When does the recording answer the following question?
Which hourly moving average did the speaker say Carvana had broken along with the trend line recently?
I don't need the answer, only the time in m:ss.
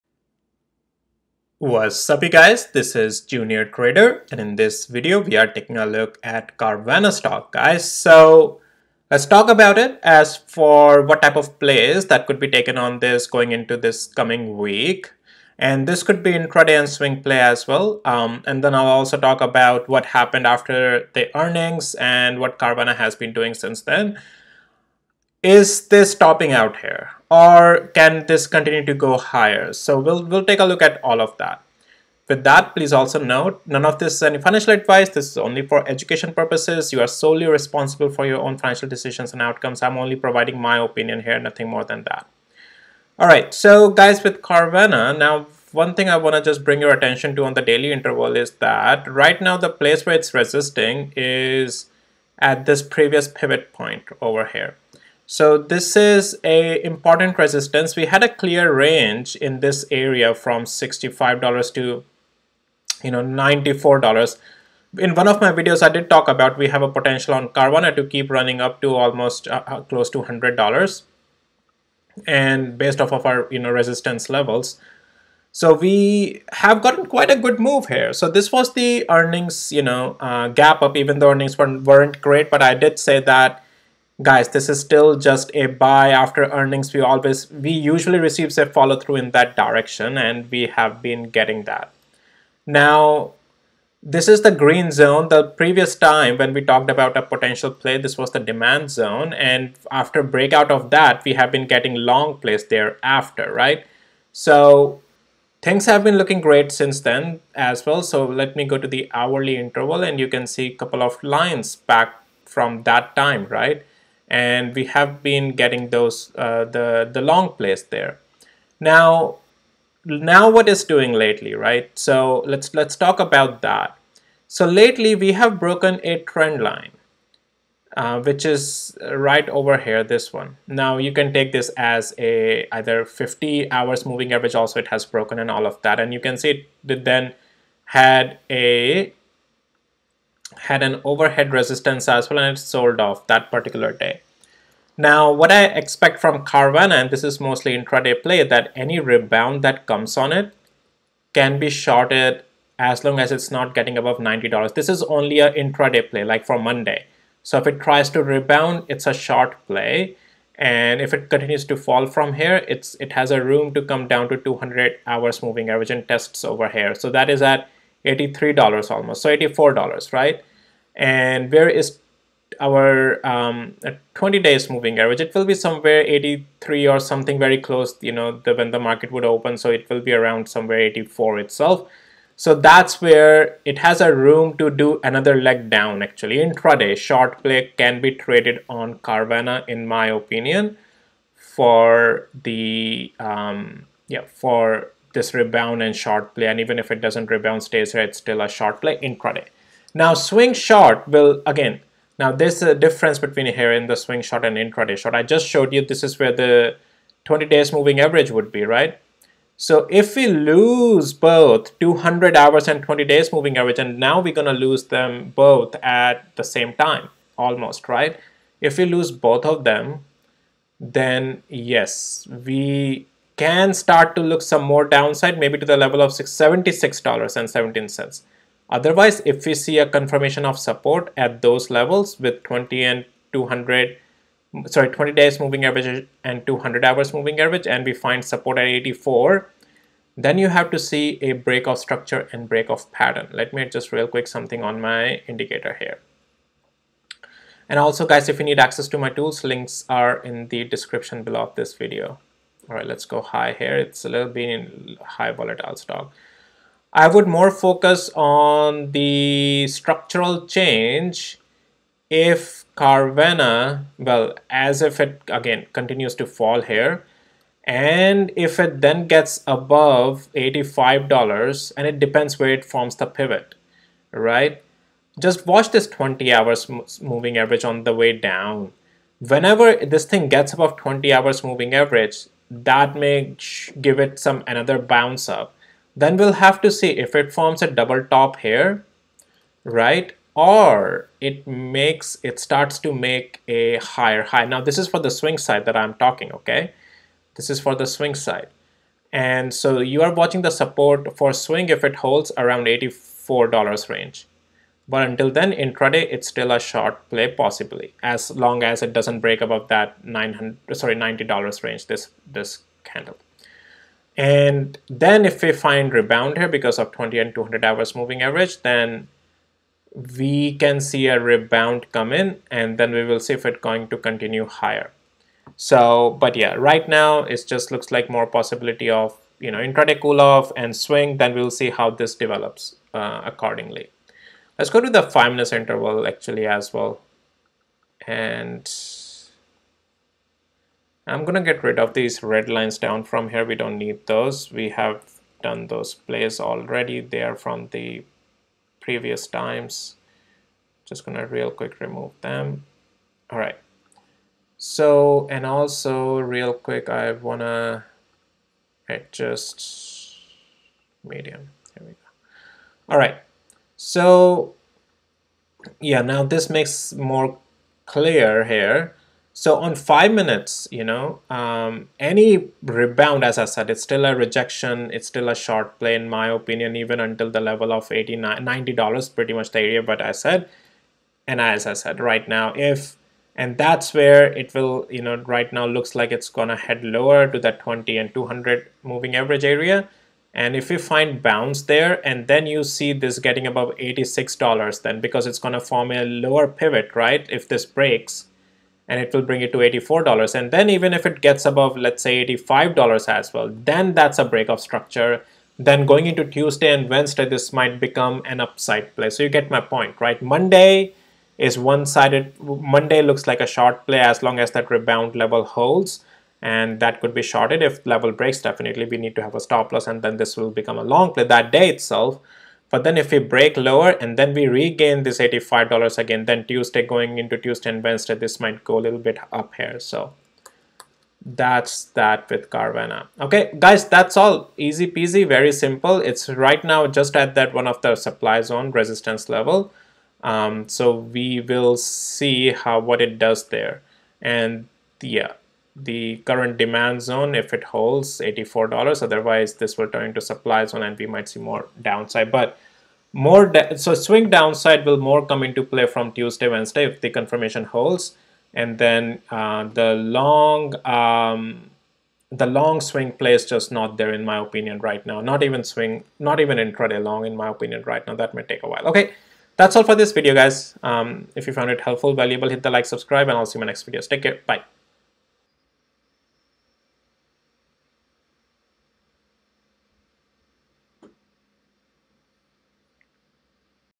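2:13.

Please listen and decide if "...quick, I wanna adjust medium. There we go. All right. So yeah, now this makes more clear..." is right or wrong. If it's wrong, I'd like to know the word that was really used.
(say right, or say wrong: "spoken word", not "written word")
right.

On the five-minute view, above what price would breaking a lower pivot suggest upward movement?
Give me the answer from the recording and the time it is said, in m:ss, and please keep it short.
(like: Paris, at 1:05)
$86, at 6:33.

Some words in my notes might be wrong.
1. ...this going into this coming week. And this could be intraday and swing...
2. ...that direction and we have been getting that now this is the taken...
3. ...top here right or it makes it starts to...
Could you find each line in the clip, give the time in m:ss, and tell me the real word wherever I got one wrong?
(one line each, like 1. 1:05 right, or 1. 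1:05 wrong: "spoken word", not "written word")
1. 0:12 right
2. 1:29 wrong: "green", not "taken"
3. 4:48 right.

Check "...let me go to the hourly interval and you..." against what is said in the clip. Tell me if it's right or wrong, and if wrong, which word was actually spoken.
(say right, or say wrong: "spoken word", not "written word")
right.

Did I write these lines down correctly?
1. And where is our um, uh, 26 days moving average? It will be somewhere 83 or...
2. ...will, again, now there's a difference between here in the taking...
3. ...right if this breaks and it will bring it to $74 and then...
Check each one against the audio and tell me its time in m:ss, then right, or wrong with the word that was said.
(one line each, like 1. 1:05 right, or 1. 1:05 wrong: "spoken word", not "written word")
1. 2:50 wrong: "20", not "26"
2. 3:21 wrong: "swing", not "taking"
3. 6:36 wrong: "84", not "74".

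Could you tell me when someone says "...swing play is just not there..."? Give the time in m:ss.
7:42.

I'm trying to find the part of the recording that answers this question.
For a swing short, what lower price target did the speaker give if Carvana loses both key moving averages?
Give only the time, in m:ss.
3:46.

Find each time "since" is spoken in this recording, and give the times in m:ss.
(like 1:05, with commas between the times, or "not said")
0:23, 1:46.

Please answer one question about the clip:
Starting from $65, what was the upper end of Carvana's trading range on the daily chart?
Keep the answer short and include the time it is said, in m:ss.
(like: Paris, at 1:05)
$94, at 1:03.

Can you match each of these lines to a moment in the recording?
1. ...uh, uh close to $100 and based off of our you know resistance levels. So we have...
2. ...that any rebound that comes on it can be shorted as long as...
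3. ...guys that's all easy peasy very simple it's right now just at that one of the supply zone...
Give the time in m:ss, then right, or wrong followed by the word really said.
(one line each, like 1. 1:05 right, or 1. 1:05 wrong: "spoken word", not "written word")
1. 1:09 right
2. 2:28 right
3. 7:13 right.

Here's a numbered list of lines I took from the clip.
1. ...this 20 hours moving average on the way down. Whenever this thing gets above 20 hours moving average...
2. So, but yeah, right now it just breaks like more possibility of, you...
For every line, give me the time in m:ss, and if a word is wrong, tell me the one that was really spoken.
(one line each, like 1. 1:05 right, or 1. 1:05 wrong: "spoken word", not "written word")
1. 4:35 right
2. 5:25 wrong: "looks", not "breaks".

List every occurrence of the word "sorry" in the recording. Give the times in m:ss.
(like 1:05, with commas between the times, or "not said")
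3:54, 5:10.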